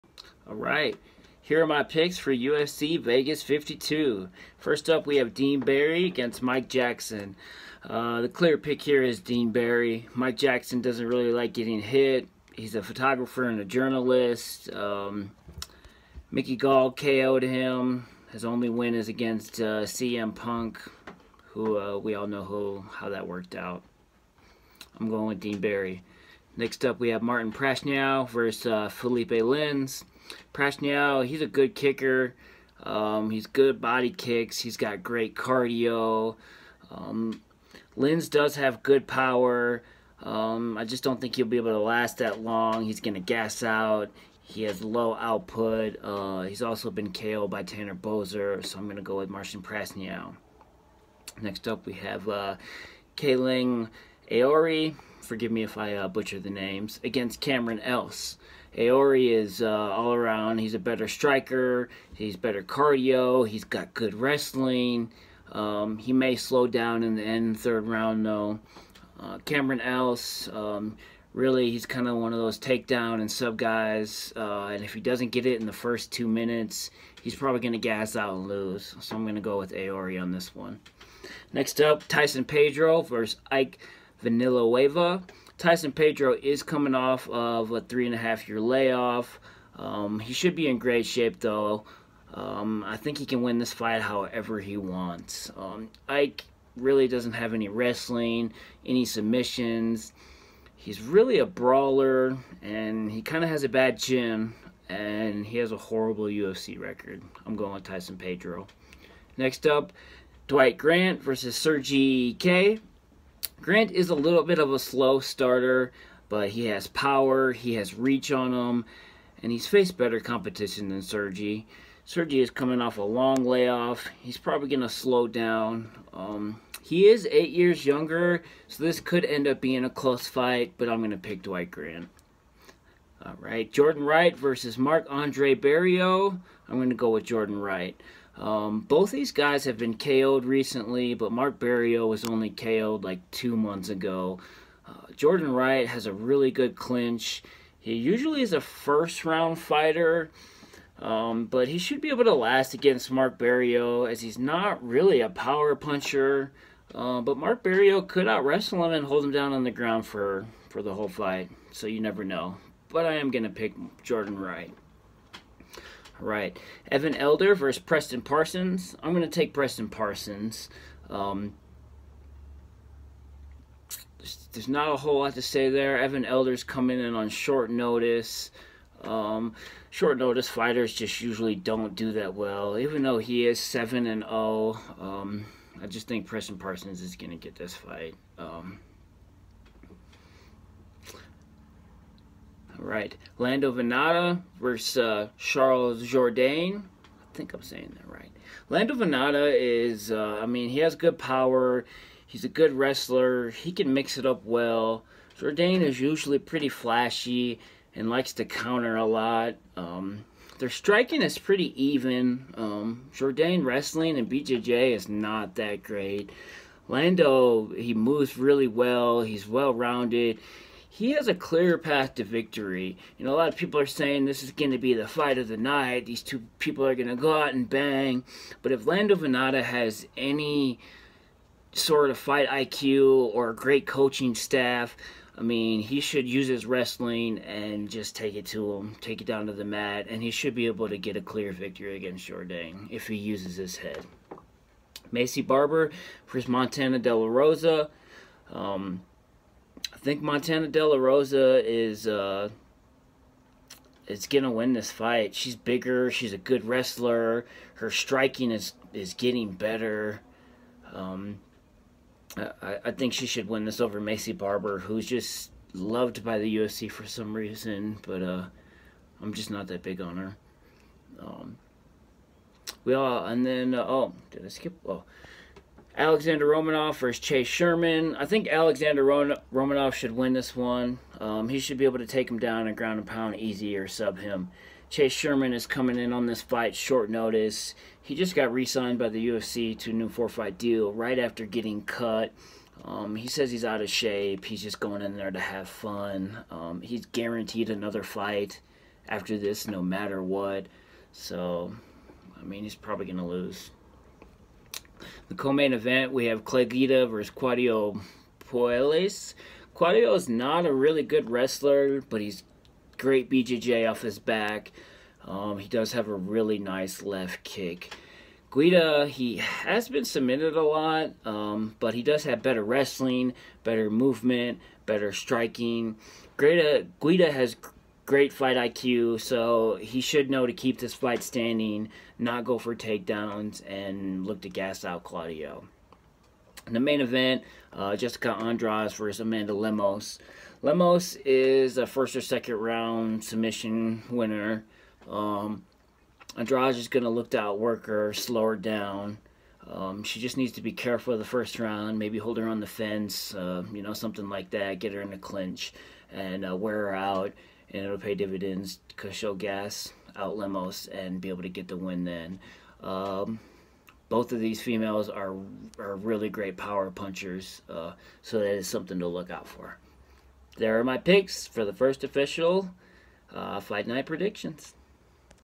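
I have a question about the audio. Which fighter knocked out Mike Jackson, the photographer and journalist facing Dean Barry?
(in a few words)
Mickey Gall.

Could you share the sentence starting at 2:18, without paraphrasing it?
Um, both these guys have been KO'd recently, but Mark Barriault was only KO'd like two months ago.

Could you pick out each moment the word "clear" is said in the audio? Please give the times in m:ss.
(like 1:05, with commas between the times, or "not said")
0:08, 3:41, 4:01.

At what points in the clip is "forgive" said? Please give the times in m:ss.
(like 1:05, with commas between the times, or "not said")
0:55.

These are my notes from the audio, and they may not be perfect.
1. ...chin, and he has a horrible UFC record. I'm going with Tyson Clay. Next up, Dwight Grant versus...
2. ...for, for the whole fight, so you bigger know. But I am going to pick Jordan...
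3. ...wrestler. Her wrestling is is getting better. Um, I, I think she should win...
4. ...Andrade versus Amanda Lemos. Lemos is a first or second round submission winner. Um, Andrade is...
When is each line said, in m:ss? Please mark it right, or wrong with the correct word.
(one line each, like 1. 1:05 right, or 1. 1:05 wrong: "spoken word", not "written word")
1. 1:43 wrong: "Pedro", not "Clay"
2. 2:40 wrong: "never", not "bigger"
3. 4:16 wrong: "striking", not "wrestling"
4. 5:38 right.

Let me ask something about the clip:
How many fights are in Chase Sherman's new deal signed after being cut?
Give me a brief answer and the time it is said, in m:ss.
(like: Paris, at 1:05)
4, at 4:50.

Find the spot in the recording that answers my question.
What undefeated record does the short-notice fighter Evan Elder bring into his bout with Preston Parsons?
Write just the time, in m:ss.
3:03.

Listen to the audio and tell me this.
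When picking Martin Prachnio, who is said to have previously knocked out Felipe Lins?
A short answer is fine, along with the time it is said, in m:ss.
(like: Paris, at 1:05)
Tanner Boser, at 0:47.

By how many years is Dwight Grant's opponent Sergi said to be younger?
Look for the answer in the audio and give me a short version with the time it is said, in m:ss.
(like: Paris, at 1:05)
8, at 2:07.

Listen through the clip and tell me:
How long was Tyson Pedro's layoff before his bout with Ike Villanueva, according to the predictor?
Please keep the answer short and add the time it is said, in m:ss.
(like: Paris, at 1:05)
3 and a half years, at 1:27.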